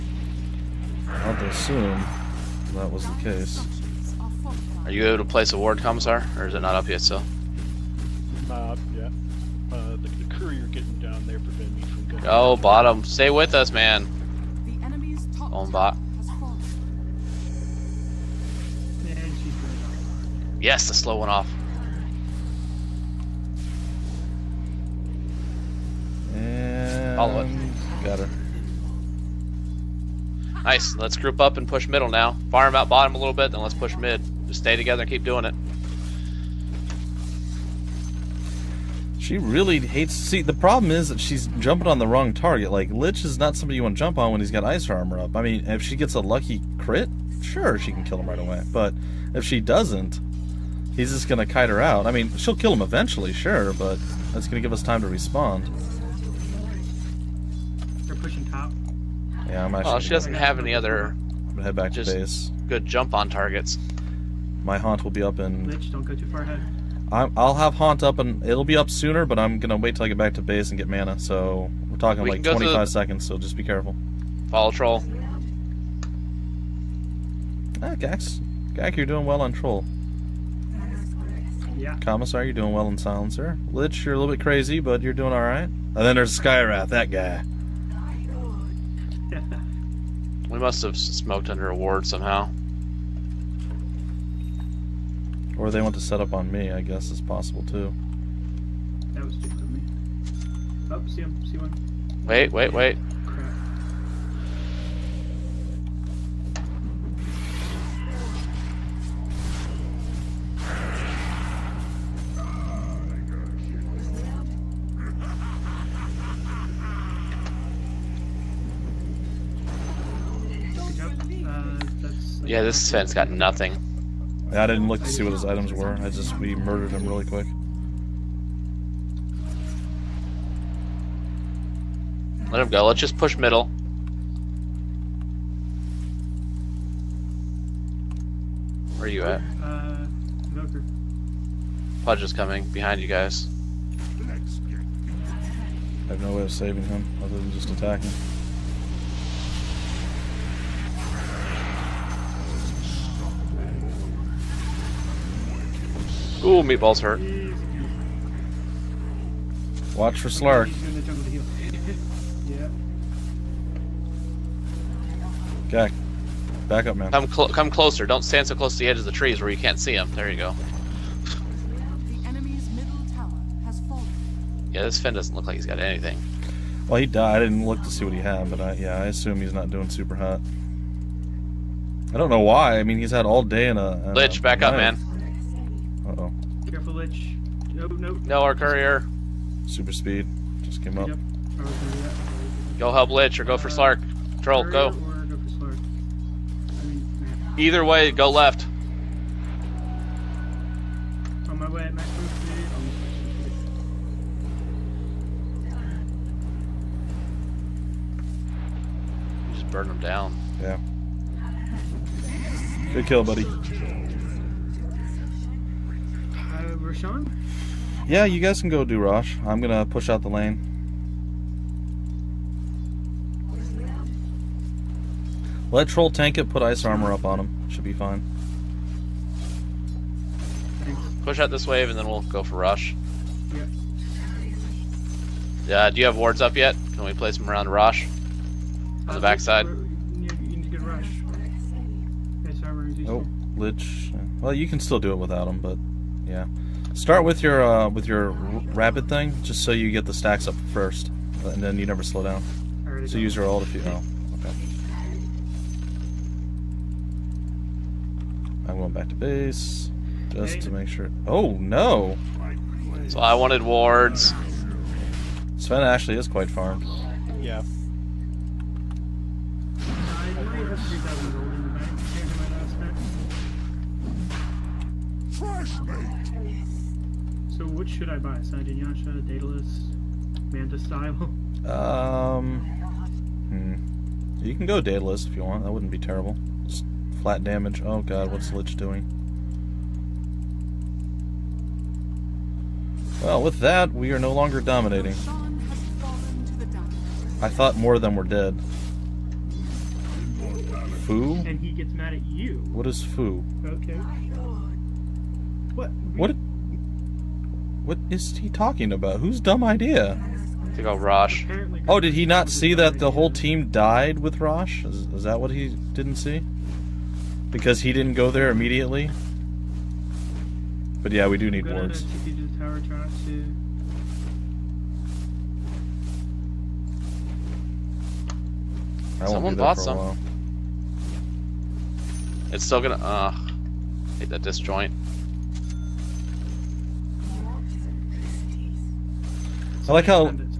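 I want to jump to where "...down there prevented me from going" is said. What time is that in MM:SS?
00:11.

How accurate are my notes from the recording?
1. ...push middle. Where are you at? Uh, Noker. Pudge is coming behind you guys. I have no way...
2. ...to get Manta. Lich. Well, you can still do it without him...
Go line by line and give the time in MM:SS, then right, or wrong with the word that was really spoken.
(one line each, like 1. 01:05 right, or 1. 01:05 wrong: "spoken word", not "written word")
1. 02:13 right
2. 04:00 wrong: "Rosh", not "Manta".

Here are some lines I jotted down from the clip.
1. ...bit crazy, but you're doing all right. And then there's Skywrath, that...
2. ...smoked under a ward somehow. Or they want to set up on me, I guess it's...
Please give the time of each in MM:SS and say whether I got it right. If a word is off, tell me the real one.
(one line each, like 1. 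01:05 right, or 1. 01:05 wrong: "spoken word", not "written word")
1. 01:24 right
2. 01:30 right.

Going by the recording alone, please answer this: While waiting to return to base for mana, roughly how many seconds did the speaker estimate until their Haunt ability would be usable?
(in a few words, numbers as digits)
25.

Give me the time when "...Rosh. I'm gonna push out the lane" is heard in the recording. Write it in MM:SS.
03:38.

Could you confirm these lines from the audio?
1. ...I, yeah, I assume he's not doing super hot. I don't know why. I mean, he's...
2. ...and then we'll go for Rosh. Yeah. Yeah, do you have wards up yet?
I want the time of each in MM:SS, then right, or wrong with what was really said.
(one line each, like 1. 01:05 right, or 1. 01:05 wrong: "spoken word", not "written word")
1. 02:58 right
2. 03:51 right.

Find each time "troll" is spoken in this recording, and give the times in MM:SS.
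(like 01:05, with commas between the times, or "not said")
01:14, 01:19, 03:14, 03:45.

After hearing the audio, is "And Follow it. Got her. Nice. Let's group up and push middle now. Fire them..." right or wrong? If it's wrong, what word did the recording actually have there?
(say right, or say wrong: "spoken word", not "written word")
right.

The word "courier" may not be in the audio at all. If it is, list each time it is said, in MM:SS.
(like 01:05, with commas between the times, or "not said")
00:10, 03:08.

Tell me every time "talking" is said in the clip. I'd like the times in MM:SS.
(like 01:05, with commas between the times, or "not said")
01:11, 05:08.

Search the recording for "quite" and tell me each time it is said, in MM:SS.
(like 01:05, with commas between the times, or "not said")
04:26.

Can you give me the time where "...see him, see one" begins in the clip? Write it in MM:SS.
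01:41.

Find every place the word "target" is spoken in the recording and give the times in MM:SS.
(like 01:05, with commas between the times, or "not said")
00:42, 01:03.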